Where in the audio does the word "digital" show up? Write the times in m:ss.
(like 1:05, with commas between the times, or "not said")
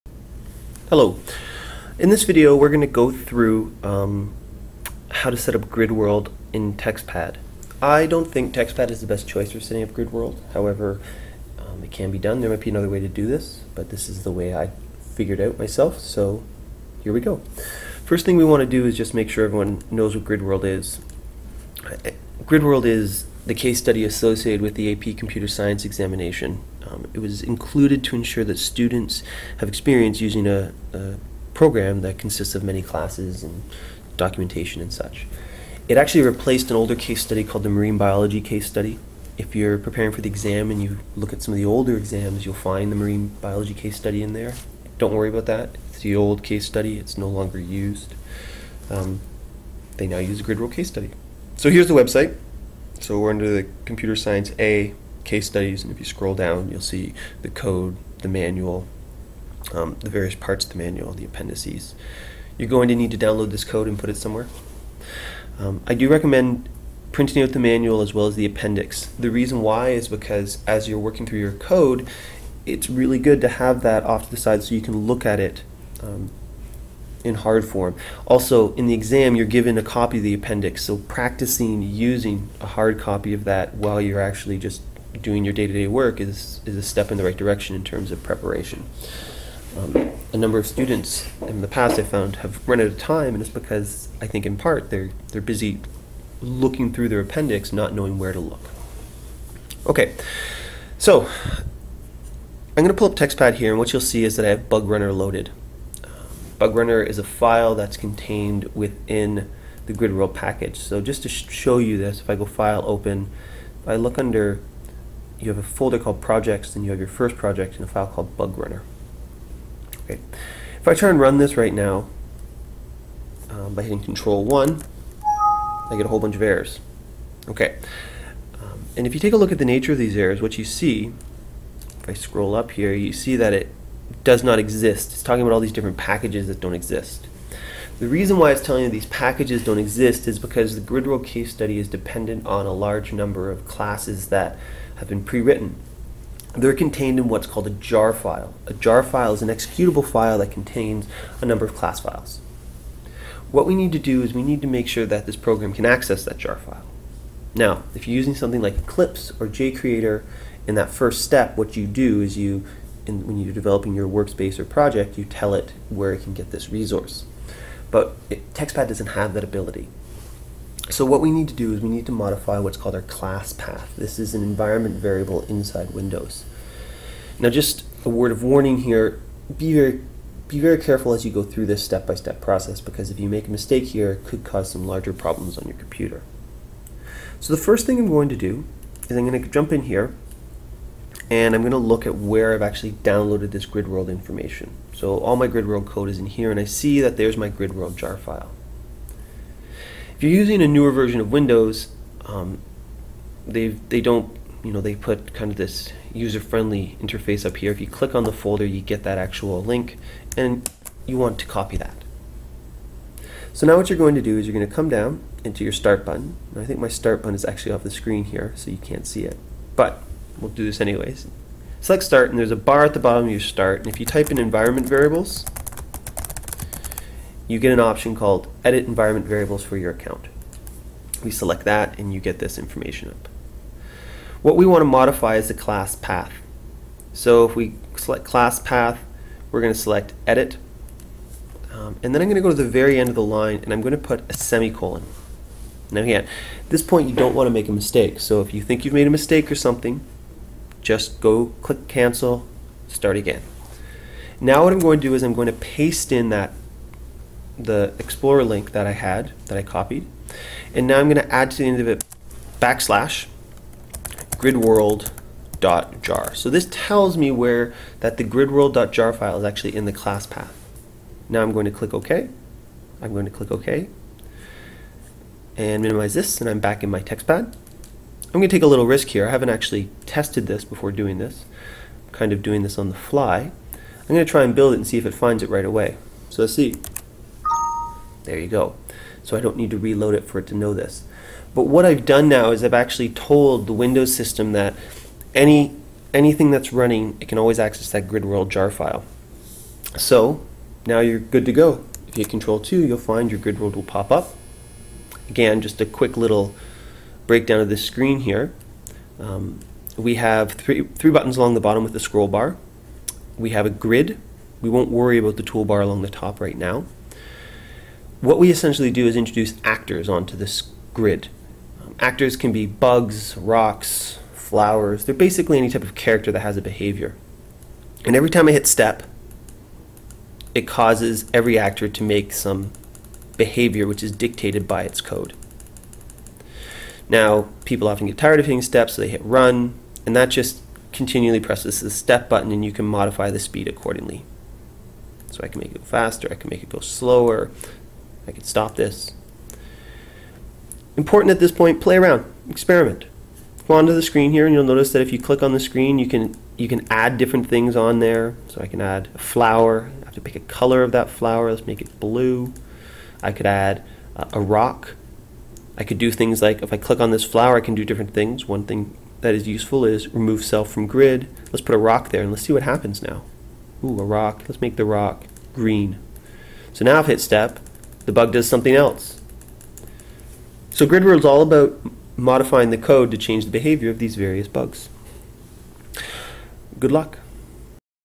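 not said.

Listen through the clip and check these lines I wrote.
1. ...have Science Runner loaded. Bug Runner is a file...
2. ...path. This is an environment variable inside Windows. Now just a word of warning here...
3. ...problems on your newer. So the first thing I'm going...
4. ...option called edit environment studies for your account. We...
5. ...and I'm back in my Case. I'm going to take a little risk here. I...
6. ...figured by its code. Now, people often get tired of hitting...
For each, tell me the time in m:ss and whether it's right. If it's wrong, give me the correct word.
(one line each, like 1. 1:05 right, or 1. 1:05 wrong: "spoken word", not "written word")
1. 1:44 wrong: "Bug", not "Science"
2. 2:53 right
3. 3:05 wrong: "computer", not "newer"
4. 3:47 wrong: "variables", not "studies"
5. 4:36 wrong: "TextPad", not "Case"
6. 5:34 wrong: "dictated", not "figured".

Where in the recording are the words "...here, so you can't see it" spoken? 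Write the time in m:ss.
3:38.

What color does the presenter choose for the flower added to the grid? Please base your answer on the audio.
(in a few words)
blue.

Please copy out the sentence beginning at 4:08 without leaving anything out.
So if you think you've made a mistake or something, just go click cancel, start again.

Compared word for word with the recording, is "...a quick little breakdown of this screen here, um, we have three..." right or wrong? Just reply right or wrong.
right.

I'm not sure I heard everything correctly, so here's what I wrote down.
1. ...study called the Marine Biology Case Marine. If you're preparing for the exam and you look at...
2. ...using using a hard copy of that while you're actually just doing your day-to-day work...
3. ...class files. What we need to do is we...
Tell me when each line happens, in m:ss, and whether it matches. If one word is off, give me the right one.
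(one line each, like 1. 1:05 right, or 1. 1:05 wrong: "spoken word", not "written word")
1. 0:37 wrong: "Study", not "Marine"
2. 1:20 wrong: "practicing", not "using"
3. 2:31 right.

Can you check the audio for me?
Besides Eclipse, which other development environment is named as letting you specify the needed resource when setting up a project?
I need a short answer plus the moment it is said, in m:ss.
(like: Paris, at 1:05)
JCreator, at 2:39.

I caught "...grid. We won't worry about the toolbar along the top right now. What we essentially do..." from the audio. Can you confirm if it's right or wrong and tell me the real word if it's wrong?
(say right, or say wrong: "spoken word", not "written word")
right.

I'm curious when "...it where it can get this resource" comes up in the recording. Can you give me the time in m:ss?
2:45.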